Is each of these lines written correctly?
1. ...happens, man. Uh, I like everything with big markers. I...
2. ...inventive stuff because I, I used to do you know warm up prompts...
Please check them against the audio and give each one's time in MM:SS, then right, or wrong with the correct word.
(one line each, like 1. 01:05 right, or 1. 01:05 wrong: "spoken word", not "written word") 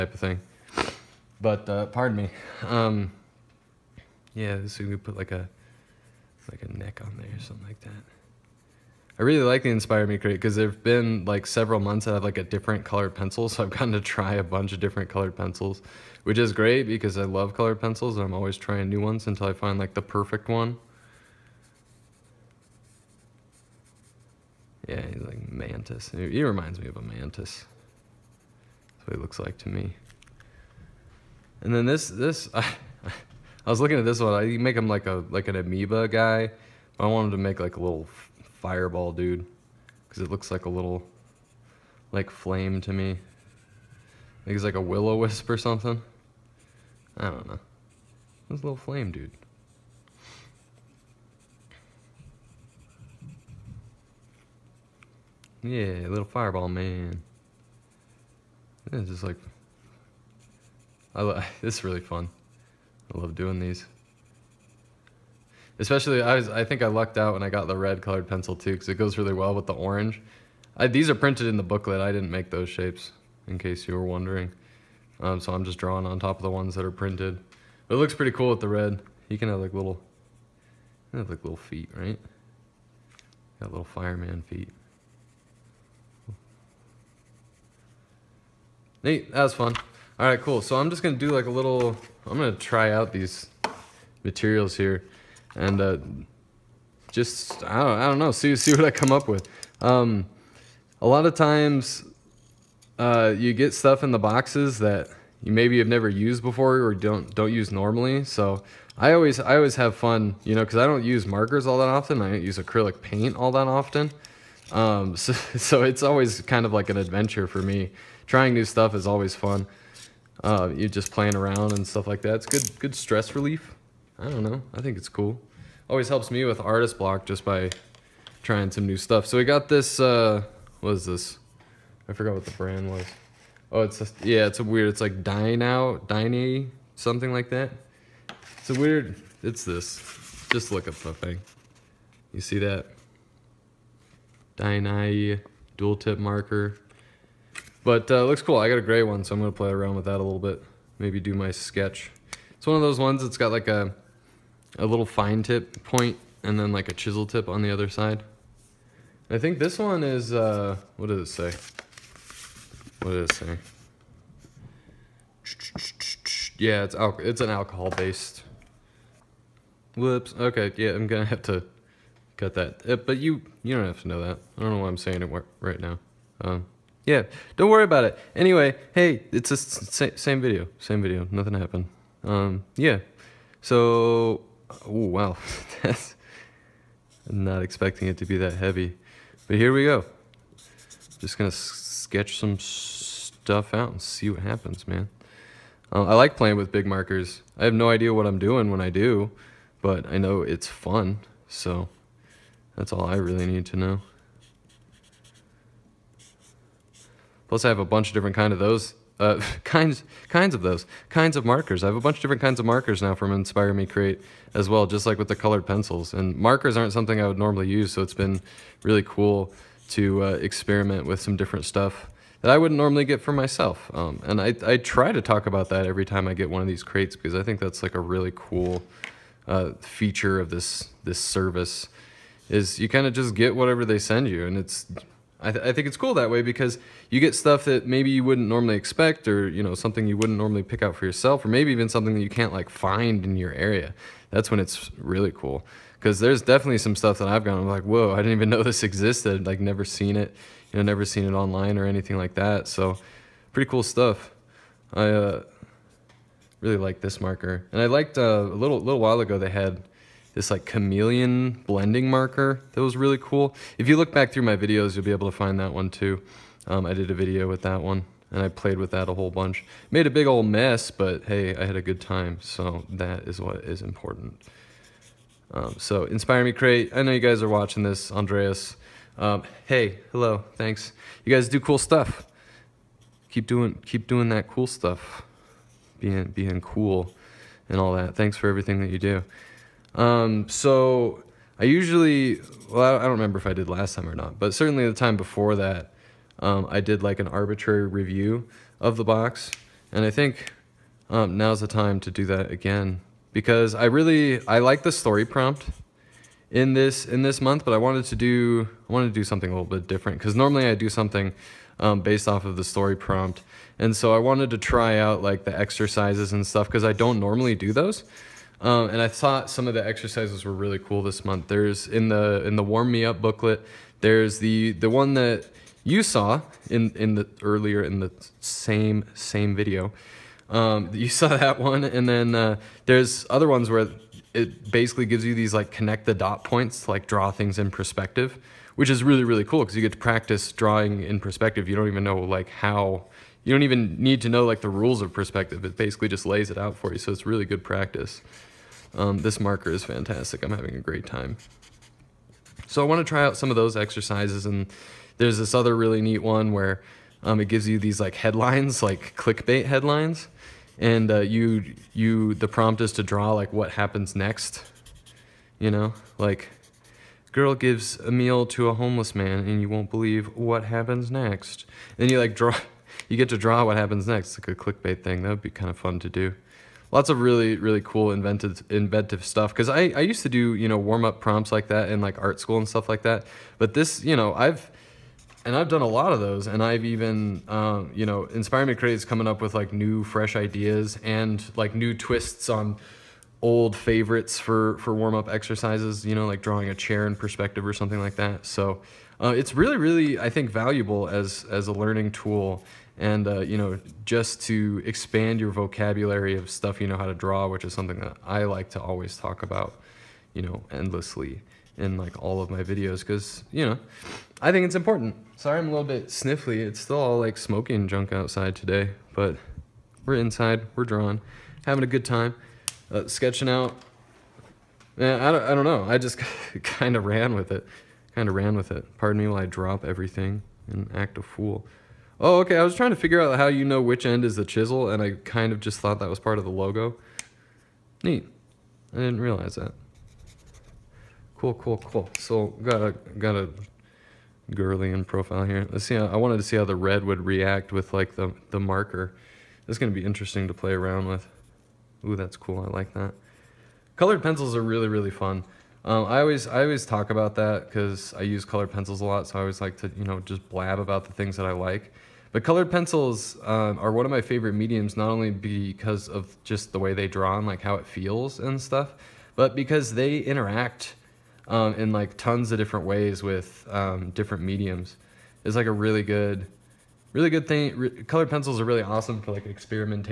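1. 03:14 wrong: "playing", not "everything"
2. 06:18 right.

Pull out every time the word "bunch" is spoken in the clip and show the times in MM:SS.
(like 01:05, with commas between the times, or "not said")
00:14, 03:27, 03:31, 04:29.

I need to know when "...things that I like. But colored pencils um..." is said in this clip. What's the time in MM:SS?
07:41.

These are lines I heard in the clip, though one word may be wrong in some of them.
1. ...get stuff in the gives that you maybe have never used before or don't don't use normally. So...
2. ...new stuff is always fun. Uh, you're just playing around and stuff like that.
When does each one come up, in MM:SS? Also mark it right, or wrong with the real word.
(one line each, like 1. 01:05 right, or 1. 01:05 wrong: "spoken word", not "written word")
1. 01:43 wrong: "boxes", not "gives"
2. 01:58 right.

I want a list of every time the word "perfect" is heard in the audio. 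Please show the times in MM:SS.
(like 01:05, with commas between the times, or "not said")
00:20.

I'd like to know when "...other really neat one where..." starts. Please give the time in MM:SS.
05:55.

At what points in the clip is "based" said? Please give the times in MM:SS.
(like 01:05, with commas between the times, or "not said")
02:47, 05:12.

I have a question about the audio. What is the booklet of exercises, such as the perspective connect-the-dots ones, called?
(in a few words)
Warm me up.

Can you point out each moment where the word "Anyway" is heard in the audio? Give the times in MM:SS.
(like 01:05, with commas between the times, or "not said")
02:58.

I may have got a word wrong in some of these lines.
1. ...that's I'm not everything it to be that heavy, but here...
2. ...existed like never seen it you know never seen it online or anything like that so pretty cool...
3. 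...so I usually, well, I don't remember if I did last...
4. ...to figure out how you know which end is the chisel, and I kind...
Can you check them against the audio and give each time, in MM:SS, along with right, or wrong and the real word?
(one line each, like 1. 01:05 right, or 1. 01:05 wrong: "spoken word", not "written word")
1. 03:05 wrong: "expecting", not "everything"
2. 04:08 right
3. 04:50 right
4. 07:12 right.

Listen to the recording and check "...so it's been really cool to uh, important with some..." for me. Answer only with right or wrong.
wrong.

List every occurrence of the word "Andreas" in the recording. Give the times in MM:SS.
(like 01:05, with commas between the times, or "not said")
04:38.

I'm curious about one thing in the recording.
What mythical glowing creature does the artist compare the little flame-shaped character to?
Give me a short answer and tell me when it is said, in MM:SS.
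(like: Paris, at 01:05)
Willow wisp, at 00:44.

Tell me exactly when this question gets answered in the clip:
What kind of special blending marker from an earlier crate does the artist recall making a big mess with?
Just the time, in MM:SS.
04:20.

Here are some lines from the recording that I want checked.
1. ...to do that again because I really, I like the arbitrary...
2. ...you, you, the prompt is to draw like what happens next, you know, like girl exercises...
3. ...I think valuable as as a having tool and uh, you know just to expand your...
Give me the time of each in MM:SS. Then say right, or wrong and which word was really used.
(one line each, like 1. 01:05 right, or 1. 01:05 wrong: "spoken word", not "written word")
1. 05:01 wrong: "story", not "arbitrary"
2. 06:01 wrong: "gives", not "exercises"
3. 06:40 wrong: "learning", not "having".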